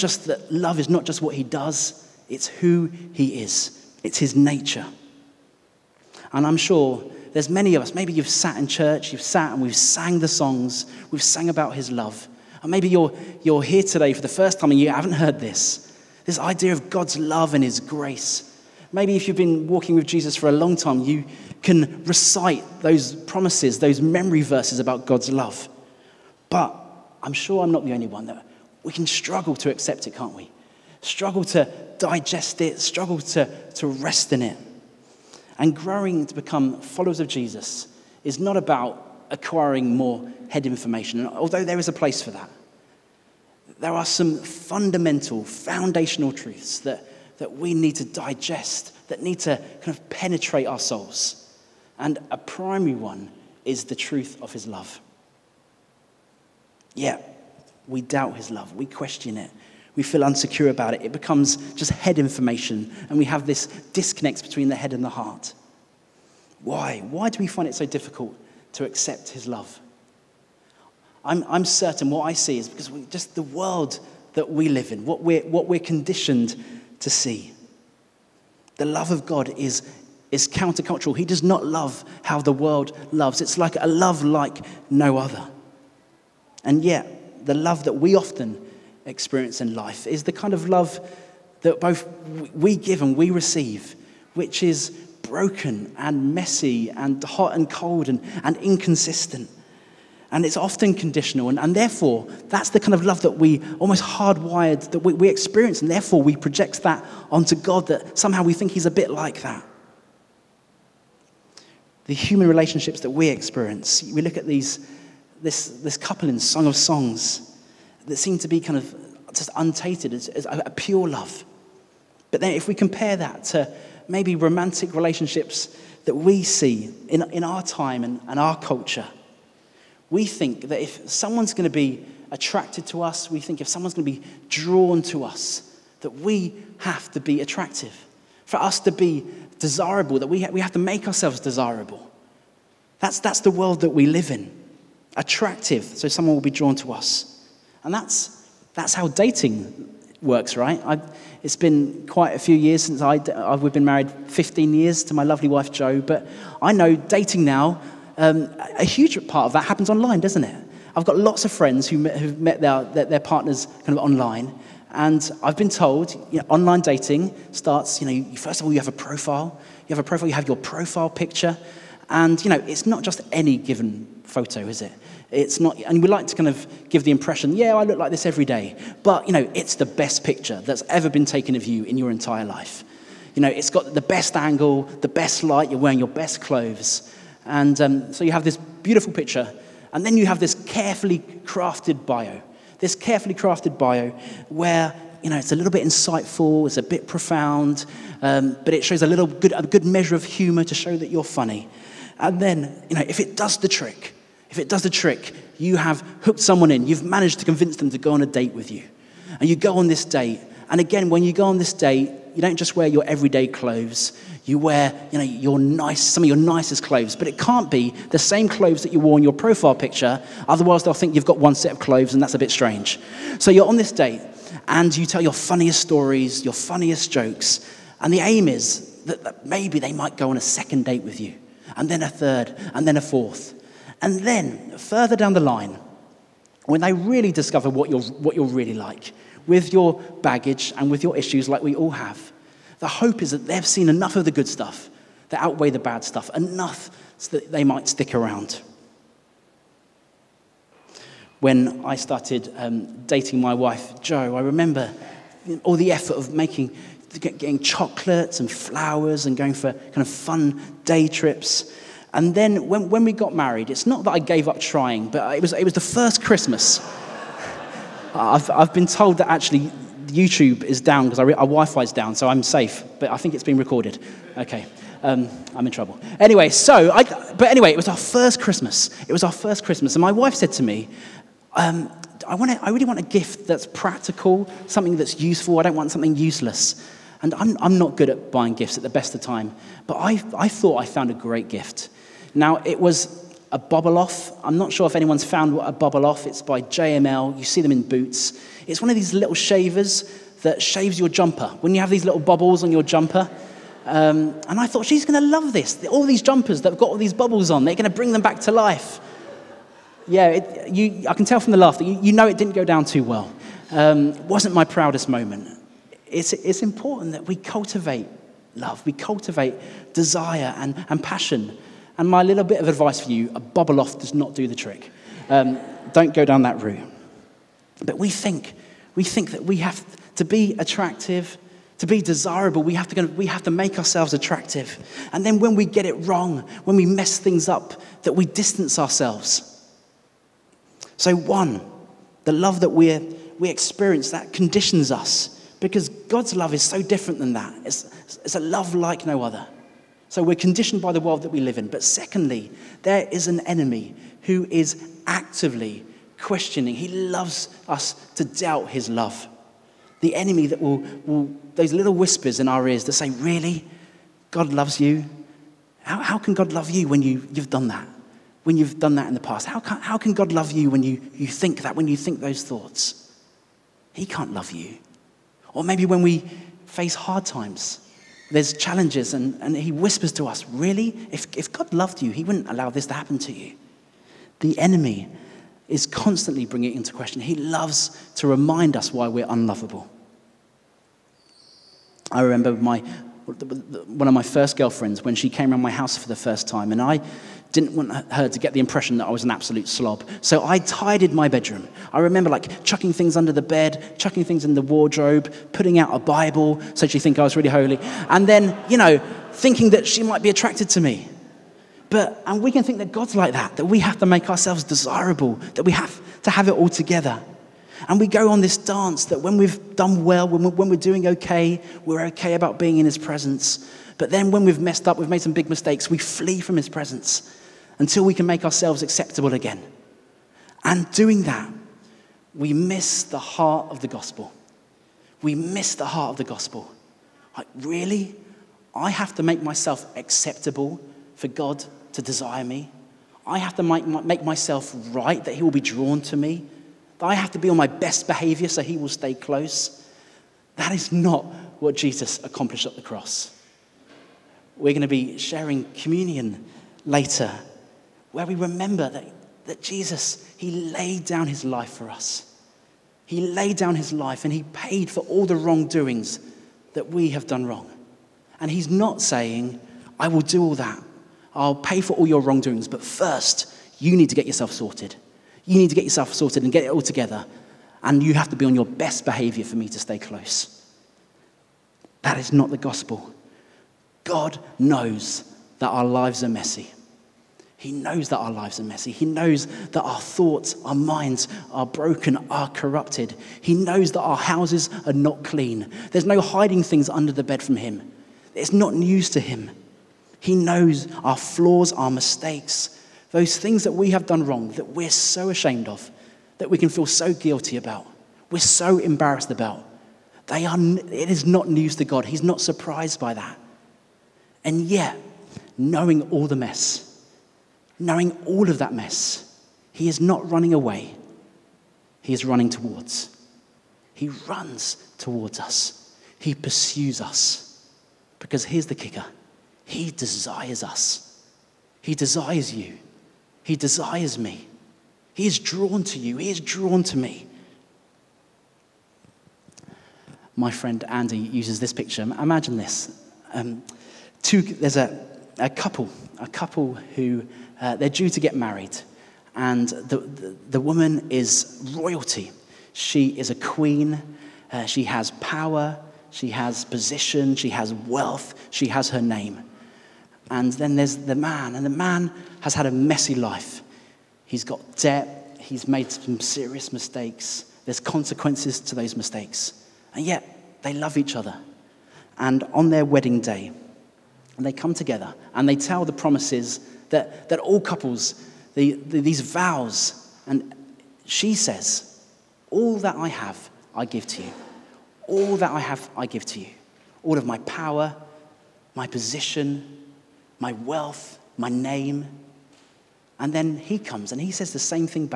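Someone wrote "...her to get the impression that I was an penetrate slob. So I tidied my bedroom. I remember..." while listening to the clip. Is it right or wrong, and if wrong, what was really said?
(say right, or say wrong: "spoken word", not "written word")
wrong: "absolute", not "penetrate".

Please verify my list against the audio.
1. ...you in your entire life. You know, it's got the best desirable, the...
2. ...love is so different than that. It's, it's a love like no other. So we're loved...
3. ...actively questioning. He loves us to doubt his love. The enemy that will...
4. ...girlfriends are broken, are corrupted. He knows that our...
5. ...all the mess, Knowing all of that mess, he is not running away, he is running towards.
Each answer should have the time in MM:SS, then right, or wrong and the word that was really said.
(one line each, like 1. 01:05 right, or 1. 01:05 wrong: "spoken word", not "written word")
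1. 03:01 wrong: "angle", not "desirable"
2. 05:46 wrong: "conditioned", not "loved"
3. 05:55 right
4. 08:10 wrong: "minds", not "girlfriends"
5. 08:36 right.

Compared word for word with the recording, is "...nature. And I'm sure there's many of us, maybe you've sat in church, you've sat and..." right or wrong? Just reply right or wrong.
right.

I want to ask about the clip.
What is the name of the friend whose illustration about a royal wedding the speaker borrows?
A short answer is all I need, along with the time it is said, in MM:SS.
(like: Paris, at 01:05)
Andy, at 09:00.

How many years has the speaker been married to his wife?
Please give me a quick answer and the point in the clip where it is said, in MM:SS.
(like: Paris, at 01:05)
15, at 02:34.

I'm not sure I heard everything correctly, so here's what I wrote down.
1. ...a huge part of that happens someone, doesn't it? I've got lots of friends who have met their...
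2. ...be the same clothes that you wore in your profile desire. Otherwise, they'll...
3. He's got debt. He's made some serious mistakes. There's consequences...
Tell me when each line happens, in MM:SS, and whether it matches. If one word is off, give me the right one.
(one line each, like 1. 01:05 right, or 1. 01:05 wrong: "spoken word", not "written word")
1. 02:38 wrong: "online", not "someone"
2. 03:37 wrong: "picture", not "desire"
3. 09:24 right.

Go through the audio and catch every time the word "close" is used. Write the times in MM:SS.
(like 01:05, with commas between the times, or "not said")
07:29, 07:59.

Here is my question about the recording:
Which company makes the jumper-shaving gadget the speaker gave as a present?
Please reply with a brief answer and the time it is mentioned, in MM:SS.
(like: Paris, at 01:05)
JML, at 04:56.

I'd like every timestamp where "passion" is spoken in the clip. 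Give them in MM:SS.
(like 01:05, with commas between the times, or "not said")
05:21.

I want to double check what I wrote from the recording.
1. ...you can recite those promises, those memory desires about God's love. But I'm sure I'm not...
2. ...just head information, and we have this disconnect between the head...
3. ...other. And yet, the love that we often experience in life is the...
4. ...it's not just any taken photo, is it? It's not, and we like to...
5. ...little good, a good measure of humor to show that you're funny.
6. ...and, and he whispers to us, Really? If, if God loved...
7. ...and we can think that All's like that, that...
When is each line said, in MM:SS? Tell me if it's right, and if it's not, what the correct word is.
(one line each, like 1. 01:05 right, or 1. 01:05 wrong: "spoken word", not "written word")
1. 00:20 wrong: "verses", not "desires"
2. 01:01 right
3. 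01:25 right
4. 02:52 wrong: "given", not "taken"
5. 03:19 right
6. 06:19 right
7. 06:52 wrong: "God", not "All".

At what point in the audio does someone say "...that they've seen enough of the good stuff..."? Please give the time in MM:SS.
04:03.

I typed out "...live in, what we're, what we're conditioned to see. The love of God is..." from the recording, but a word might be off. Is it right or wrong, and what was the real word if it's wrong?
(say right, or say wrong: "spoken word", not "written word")
right.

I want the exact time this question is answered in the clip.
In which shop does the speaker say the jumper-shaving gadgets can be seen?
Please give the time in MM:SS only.
04:57.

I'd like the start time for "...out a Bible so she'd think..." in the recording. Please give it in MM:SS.
06:45.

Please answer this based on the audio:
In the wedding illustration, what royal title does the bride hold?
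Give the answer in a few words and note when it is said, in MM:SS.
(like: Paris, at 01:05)
Queen, at 09:13.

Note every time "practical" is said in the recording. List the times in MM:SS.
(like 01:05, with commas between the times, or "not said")
04:43.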